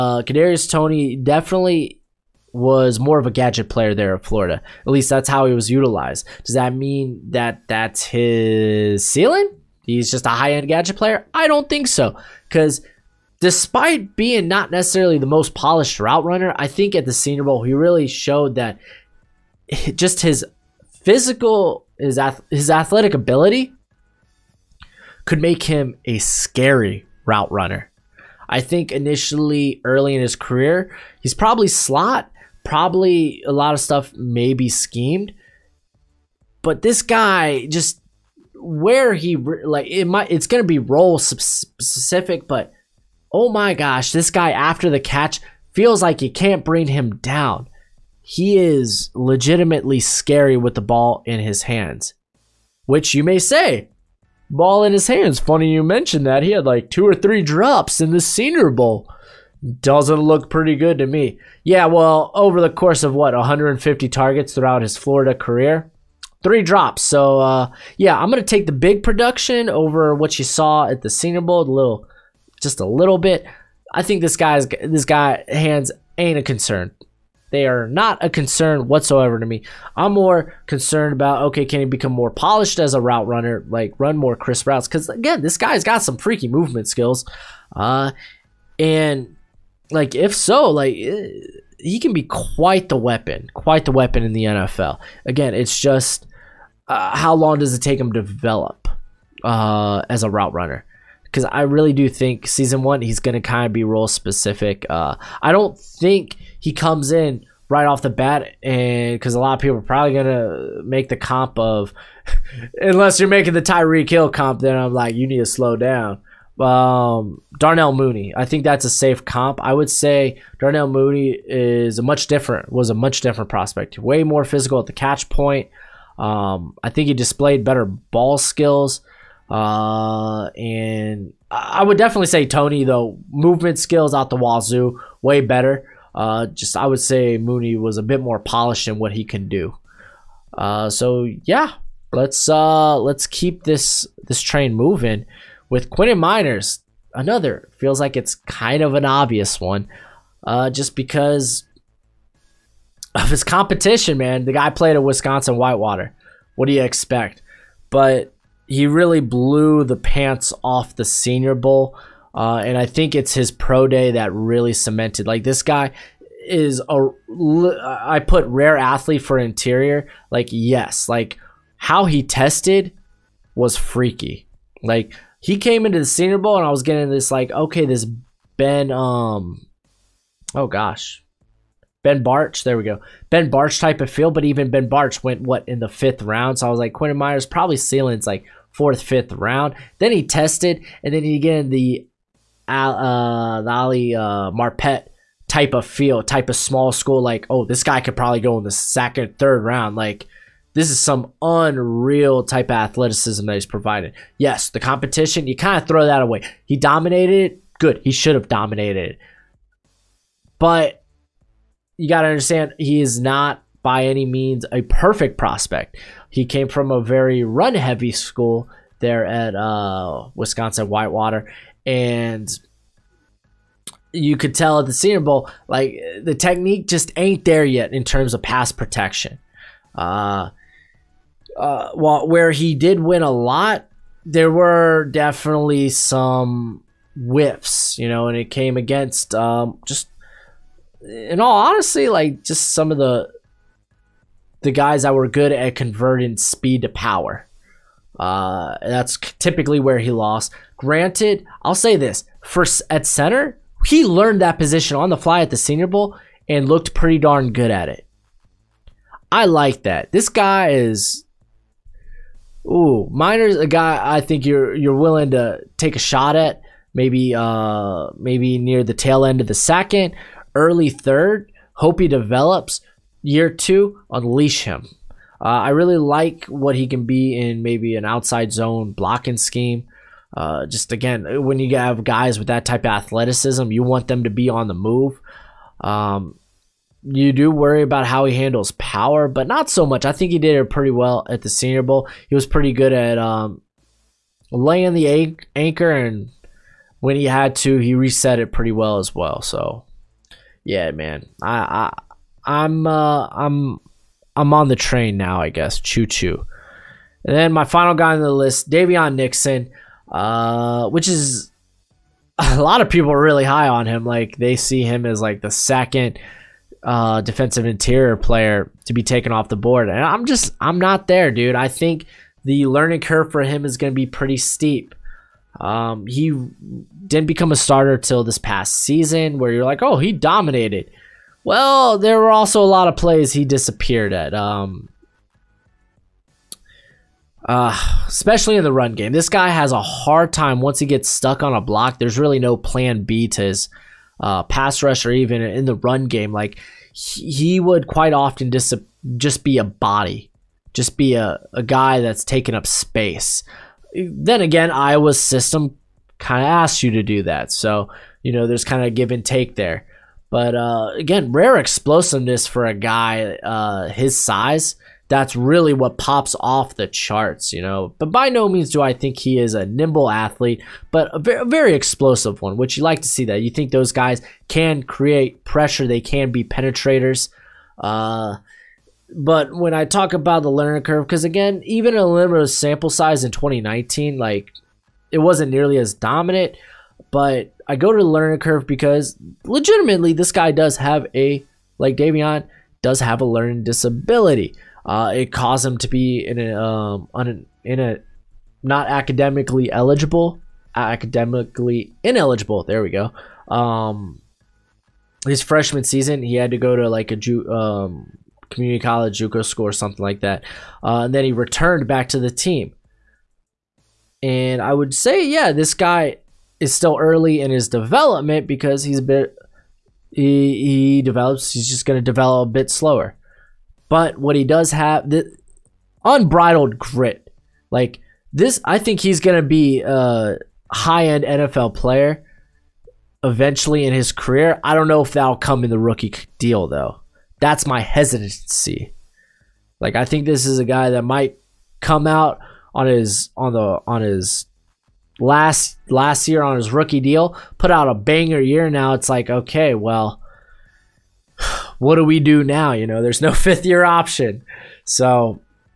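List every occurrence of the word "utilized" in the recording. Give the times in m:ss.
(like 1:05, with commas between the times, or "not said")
0:05.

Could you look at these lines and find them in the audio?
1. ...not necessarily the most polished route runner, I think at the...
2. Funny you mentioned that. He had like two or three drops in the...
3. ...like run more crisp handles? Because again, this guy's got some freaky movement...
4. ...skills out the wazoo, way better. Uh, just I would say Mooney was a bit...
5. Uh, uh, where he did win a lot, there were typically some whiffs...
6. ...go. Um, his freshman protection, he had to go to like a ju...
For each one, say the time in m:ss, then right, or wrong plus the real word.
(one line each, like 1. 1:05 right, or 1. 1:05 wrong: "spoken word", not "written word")
1. 0:14 right
2. 0:55 right
3. 1:23 wrong: "routes", not "handles"
4. 2:13 right
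5. 3:49 wrong: "definitely", not "typically"
6. 6:42 wrong: "season", not "protection".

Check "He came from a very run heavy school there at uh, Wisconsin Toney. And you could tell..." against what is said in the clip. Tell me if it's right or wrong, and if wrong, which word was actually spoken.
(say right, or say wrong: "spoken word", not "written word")
wrong: "Whitewater", not "Toney".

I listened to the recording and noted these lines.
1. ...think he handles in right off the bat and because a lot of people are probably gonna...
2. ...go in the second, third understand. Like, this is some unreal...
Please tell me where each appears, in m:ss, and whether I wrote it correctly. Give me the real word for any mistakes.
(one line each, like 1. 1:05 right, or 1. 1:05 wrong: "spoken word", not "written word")
1. 1:45 wrong: "comes", not "handles"
2. 3:18 wrong: "round", not "understand".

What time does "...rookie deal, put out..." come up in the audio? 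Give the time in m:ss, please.
7:26.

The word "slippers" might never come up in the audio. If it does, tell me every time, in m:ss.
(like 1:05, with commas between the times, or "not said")
not said.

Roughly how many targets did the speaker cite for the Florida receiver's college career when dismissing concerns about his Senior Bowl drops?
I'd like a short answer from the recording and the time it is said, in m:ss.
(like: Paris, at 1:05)
150, at 1:03.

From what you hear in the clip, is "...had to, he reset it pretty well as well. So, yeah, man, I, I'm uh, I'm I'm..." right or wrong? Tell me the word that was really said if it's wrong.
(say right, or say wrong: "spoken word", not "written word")
right.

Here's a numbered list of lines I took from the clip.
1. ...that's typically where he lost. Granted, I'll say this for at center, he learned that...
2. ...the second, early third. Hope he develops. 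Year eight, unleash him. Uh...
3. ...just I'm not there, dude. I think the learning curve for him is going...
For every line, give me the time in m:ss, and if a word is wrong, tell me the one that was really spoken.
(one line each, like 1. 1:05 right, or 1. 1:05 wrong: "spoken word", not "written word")
1. 4:08 right
2. 4:29 wrong: "two", not "eight"
3. 5:20 right.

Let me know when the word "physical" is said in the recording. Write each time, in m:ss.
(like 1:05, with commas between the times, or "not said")
0:21, 2:04.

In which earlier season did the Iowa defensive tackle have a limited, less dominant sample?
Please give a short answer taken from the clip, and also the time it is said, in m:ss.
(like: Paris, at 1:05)
2019, at 6:23.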